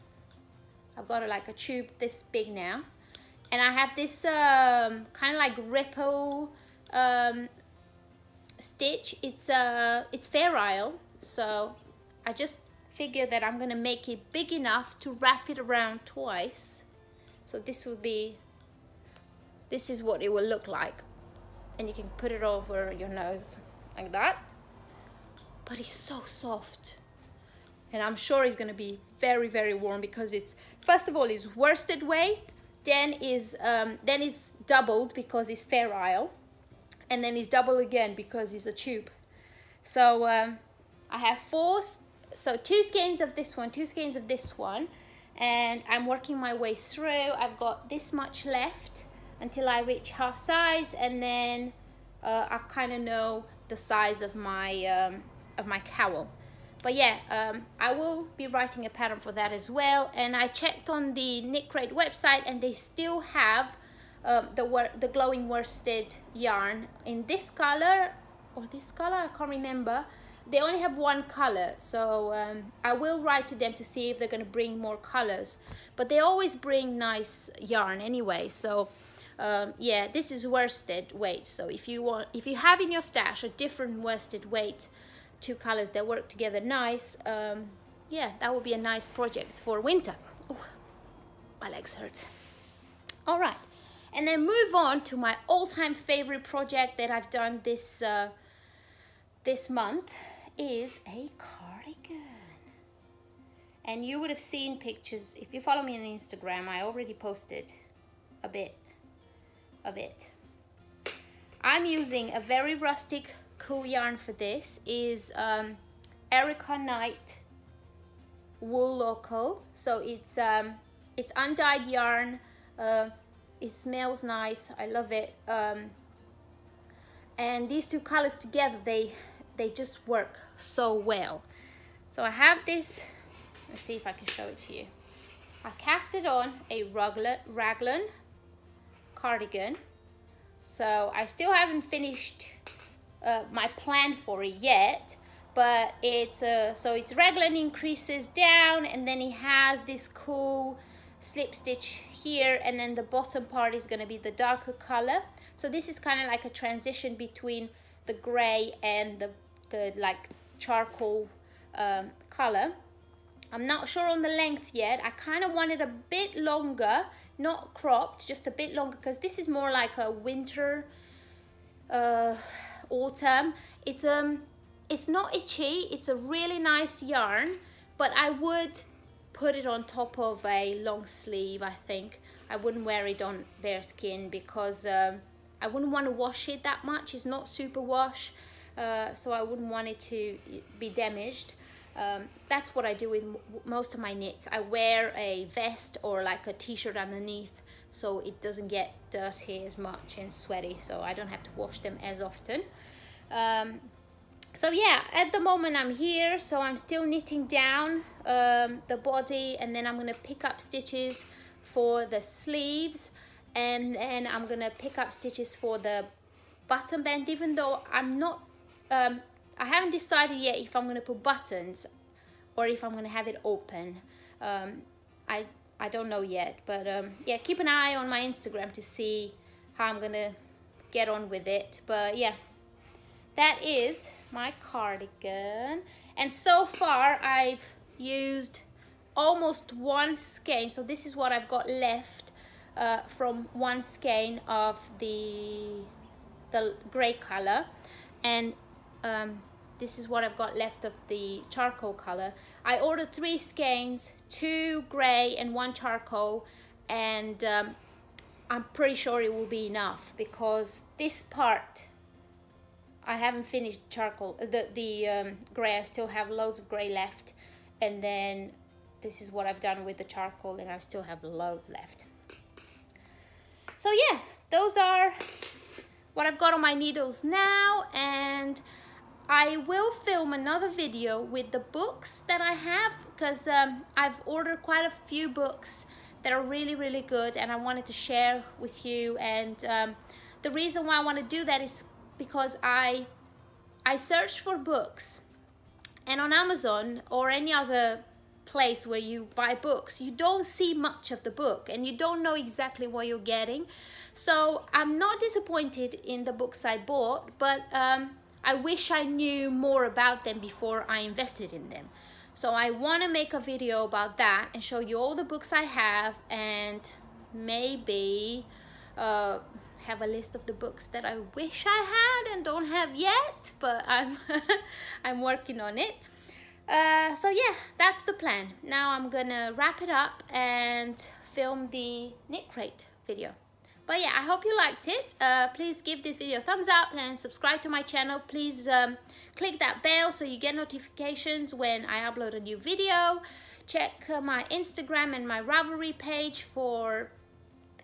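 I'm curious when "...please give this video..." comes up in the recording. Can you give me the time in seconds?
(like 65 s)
335 s.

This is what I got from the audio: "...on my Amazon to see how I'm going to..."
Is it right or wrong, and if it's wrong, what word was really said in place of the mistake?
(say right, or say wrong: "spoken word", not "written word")
wrong: "Instagram", not "Amazon".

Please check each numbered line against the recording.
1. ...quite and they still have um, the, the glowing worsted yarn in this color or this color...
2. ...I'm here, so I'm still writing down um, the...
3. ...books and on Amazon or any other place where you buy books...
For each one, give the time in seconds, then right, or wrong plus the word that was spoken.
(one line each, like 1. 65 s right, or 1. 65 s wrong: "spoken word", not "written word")
1. 62 s wrong: "website", not "quite"
2. 205 s wrong: "knitting", not "writing"
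3. 294 s right.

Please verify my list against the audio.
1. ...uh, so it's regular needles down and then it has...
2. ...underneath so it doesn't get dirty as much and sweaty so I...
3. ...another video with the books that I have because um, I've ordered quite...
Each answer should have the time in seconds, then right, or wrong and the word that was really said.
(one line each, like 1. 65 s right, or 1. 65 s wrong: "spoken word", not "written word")
1. 146 s wrong: "increases", not "needles"
2. 196 s right
3. 280 s right.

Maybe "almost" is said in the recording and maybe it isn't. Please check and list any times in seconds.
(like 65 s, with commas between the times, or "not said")
239 s.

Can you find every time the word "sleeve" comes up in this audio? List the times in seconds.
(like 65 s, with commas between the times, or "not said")
181 s, 212 s.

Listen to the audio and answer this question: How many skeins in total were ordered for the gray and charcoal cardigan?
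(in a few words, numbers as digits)
3.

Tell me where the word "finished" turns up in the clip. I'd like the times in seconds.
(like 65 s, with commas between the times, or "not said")
141 s, 263 s.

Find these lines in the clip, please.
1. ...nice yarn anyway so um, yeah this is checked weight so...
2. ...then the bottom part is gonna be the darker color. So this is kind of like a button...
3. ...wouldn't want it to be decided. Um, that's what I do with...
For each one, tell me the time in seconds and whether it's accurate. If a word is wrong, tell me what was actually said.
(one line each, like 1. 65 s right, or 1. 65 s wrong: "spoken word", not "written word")
1. 76 s wrong: "worsted", not "checked"
2. 152 s wrong: "transition", not "button"
3. 189 s wrong: "damaged", not "decided".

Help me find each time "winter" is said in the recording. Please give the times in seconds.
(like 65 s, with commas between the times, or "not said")
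89 s, 170 s.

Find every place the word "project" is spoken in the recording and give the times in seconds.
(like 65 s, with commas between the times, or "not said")
89 s, 96 s.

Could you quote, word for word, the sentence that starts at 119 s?
So it's um, it's undyed yarn.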